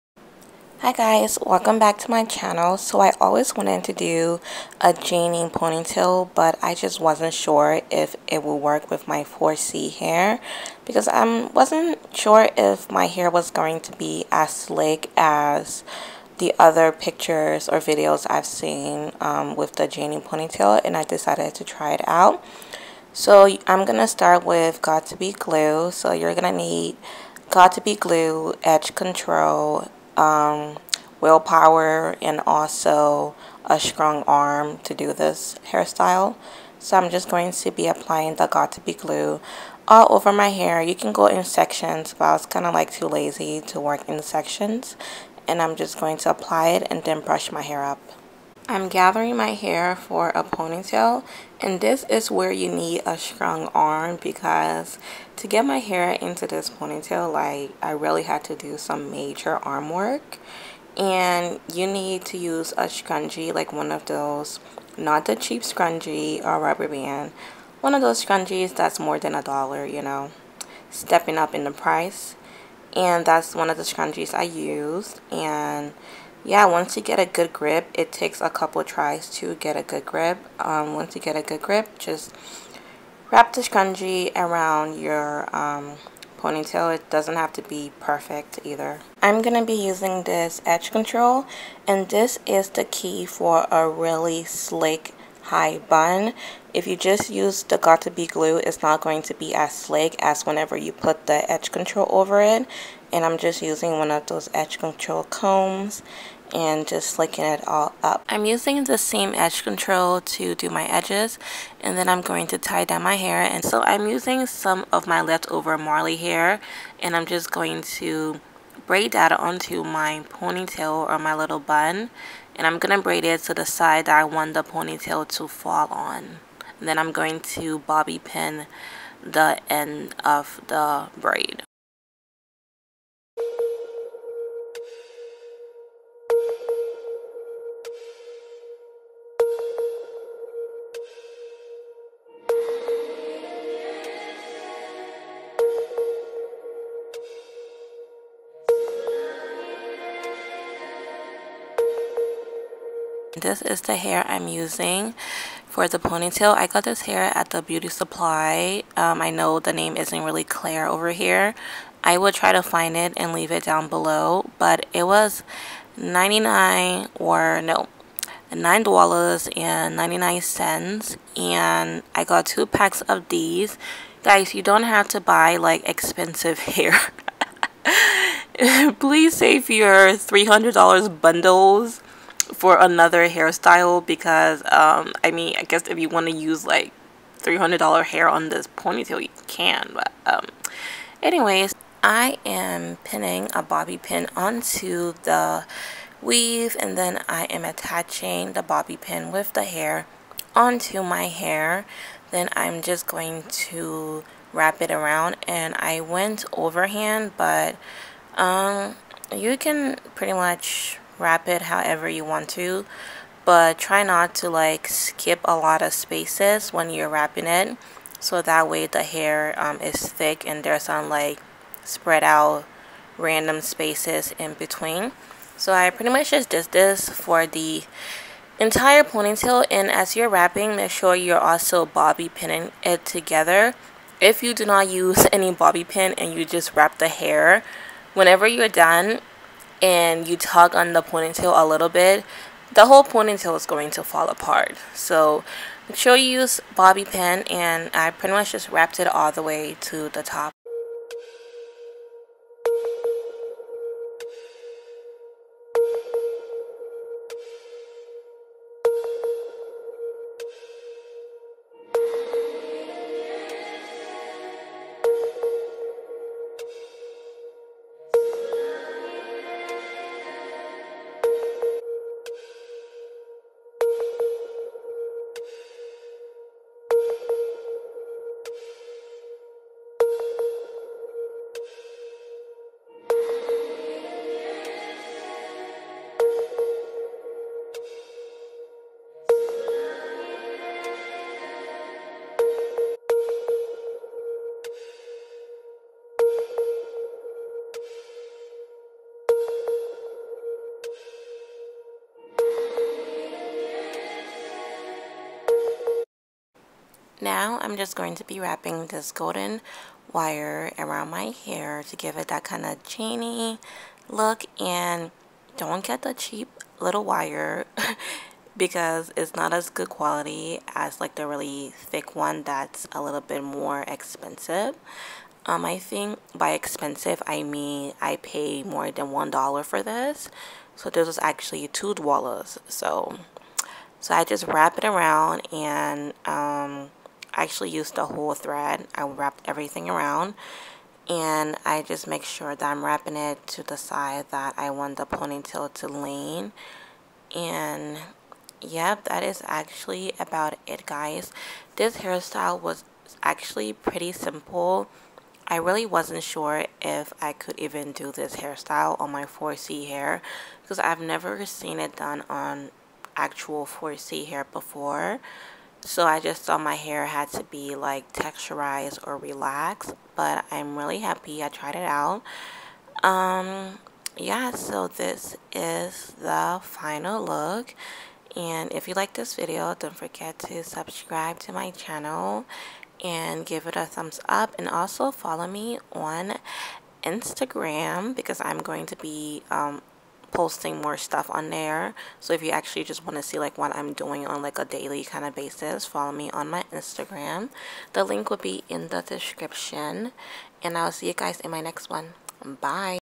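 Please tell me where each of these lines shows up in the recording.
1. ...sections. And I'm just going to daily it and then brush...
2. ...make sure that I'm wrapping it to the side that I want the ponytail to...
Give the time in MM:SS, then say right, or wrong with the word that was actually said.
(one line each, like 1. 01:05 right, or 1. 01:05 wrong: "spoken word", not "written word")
1. 00:44 wrong: "apply", not "daily"
2. 05:42 right.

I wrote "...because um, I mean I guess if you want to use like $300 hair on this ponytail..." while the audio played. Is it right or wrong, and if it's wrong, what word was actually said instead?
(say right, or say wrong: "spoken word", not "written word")
right.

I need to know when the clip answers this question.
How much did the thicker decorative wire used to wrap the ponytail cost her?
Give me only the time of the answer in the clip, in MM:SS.
05:31.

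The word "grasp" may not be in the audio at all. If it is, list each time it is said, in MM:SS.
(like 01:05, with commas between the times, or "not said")
not said.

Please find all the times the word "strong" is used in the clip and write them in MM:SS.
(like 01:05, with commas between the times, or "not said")
00:33, 00:53.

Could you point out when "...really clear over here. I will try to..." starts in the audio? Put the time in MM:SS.
02:40.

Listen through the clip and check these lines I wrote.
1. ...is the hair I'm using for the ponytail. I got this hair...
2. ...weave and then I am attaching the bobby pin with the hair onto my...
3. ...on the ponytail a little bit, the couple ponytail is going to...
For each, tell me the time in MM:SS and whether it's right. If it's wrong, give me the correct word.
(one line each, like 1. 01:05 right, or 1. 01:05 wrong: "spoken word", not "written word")
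1. 02:33 right
2. 03:16 right
3. 04:00 wrong: "whole", not "couple".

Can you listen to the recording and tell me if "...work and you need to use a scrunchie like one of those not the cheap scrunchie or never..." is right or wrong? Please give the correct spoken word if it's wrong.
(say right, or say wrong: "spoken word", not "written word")
wrong: "rubber", not "never".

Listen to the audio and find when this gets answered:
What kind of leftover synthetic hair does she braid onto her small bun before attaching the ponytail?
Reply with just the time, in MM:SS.
01:55.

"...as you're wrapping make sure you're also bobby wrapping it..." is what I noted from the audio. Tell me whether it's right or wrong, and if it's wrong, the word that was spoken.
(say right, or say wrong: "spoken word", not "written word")
wrong: "pinning", not "wrapping".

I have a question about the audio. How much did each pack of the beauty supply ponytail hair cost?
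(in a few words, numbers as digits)
$9.99.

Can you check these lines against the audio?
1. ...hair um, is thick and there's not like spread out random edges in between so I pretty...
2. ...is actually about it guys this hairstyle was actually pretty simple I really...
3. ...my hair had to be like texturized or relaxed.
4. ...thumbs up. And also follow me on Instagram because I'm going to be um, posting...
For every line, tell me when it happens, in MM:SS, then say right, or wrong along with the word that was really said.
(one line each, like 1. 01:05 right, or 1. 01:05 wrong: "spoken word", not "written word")
1. 03:39 wrong: "spaces", not "edges"
2. 05:49 right
3. 06:06 right
4. 06:23 right.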